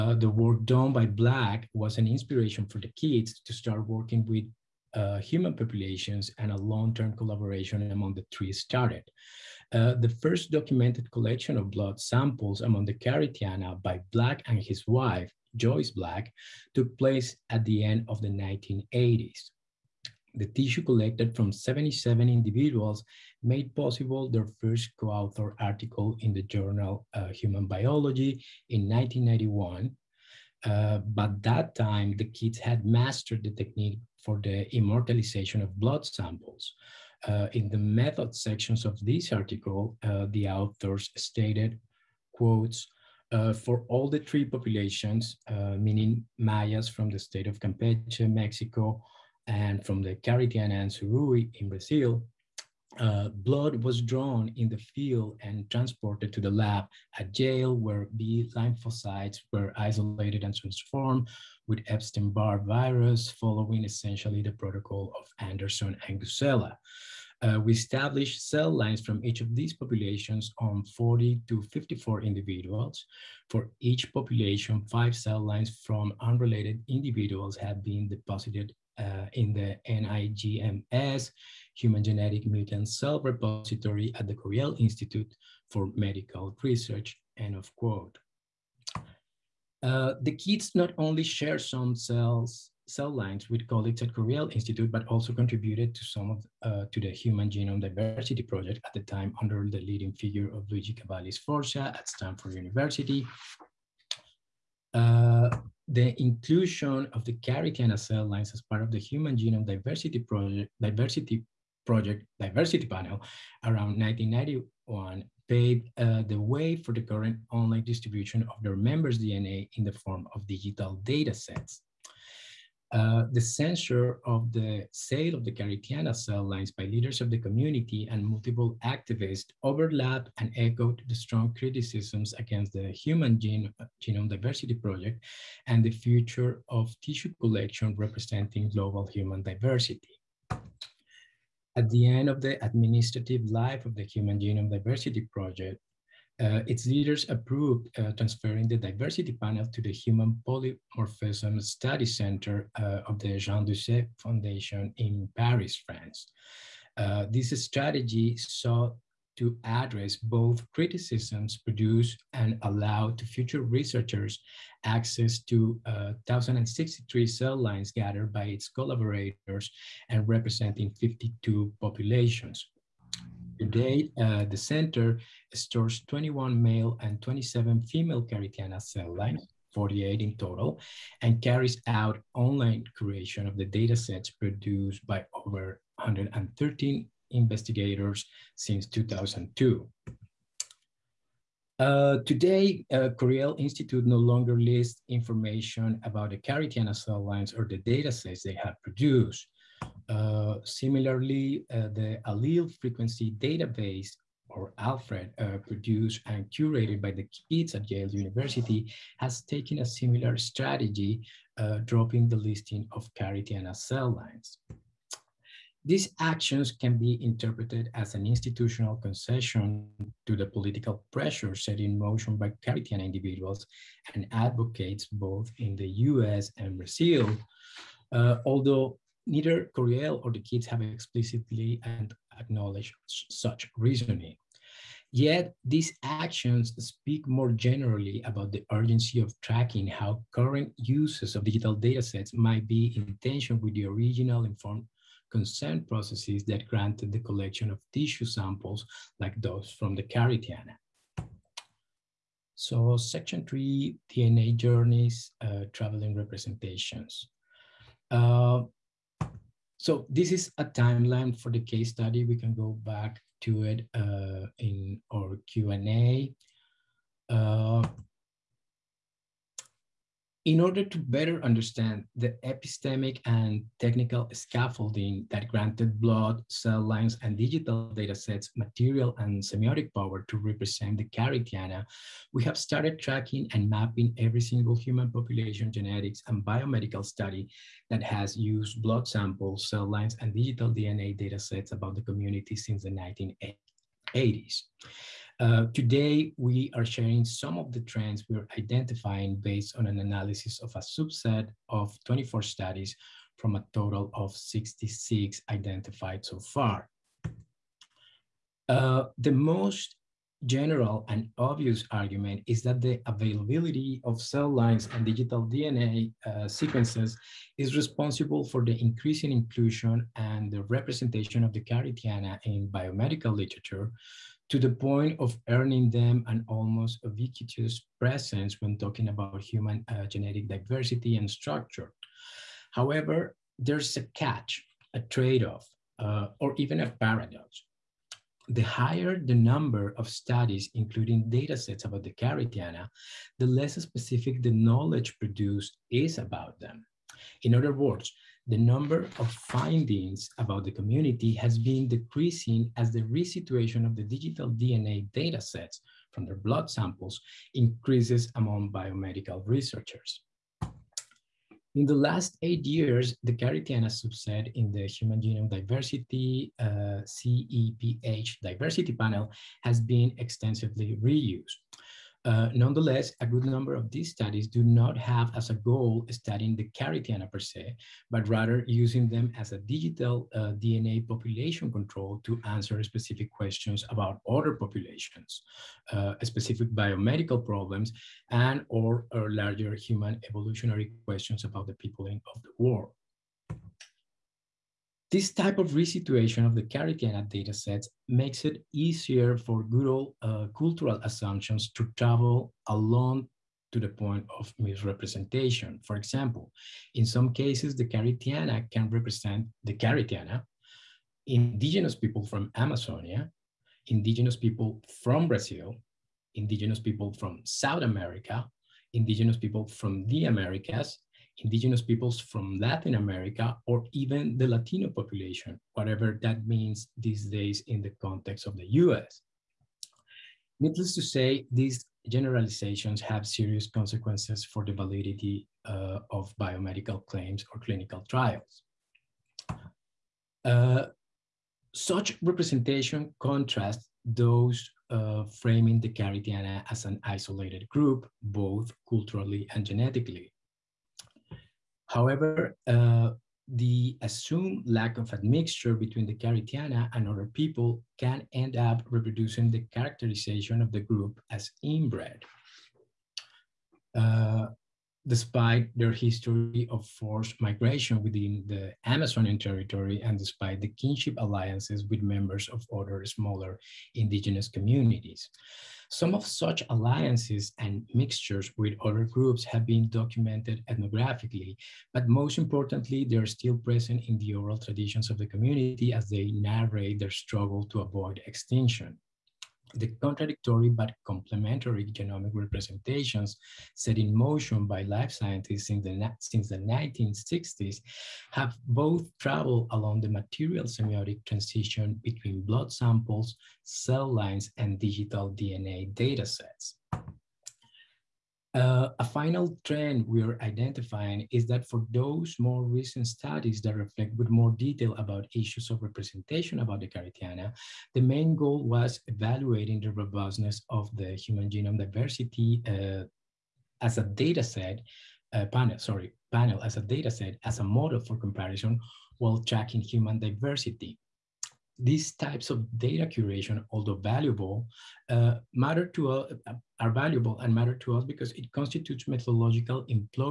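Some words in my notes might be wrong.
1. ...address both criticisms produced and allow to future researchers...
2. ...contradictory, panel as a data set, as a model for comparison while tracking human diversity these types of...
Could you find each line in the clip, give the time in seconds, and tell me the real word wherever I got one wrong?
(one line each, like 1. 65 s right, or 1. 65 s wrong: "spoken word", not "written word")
1. 159 s right
2. 525 s wrong: "sorry", not "contradictory".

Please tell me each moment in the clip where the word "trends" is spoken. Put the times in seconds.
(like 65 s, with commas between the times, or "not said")
297 s, 509 s.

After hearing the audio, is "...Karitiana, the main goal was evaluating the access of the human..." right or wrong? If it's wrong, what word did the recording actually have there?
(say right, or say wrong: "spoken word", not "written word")
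wrong: "robustness", not "access".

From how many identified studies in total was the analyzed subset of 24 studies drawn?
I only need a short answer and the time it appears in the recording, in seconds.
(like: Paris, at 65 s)
66, at 304 s.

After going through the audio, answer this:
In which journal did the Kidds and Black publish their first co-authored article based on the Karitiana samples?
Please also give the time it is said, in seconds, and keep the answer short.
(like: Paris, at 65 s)
Human Biology, at 27 s.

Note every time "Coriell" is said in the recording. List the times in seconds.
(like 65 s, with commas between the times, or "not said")
84 s, 94 s, 193 s, 229 s.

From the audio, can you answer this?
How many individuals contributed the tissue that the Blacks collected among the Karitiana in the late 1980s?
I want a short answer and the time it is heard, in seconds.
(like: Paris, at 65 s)
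77, at 21 s.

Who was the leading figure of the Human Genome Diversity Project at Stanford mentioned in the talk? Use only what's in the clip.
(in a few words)
Luigi Cavalli Sforza.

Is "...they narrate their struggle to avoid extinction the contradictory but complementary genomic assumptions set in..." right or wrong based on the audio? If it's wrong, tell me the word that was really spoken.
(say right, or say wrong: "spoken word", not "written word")
wrong: "representations", not "assumptions".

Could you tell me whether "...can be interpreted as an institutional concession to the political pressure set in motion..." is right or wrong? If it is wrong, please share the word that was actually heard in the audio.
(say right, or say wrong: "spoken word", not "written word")
right.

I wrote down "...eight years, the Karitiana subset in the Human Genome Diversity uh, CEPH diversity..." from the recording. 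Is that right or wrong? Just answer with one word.
right.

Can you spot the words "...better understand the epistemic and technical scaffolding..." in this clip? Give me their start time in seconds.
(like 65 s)
270 s.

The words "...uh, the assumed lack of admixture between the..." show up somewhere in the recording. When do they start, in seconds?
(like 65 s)
452 s.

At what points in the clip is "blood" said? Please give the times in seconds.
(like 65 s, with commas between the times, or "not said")
11 s, 35 s, 53 s, 276 s, 288 s, 356 s, 502 s.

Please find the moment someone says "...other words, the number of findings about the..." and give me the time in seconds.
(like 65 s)
347 s.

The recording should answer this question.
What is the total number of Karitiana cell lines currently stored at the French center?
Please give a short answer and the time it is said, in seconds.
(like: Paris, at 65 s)
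48, at 179 s.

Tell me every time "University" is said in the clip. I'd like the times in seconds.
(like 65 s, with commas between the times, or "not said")
102 s, 208 s.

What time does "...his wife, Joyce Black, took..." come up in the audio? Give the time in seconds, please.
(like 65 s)
14 s.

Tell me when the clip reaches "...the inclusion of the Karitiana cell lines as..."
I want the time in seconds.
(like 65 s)
105 s.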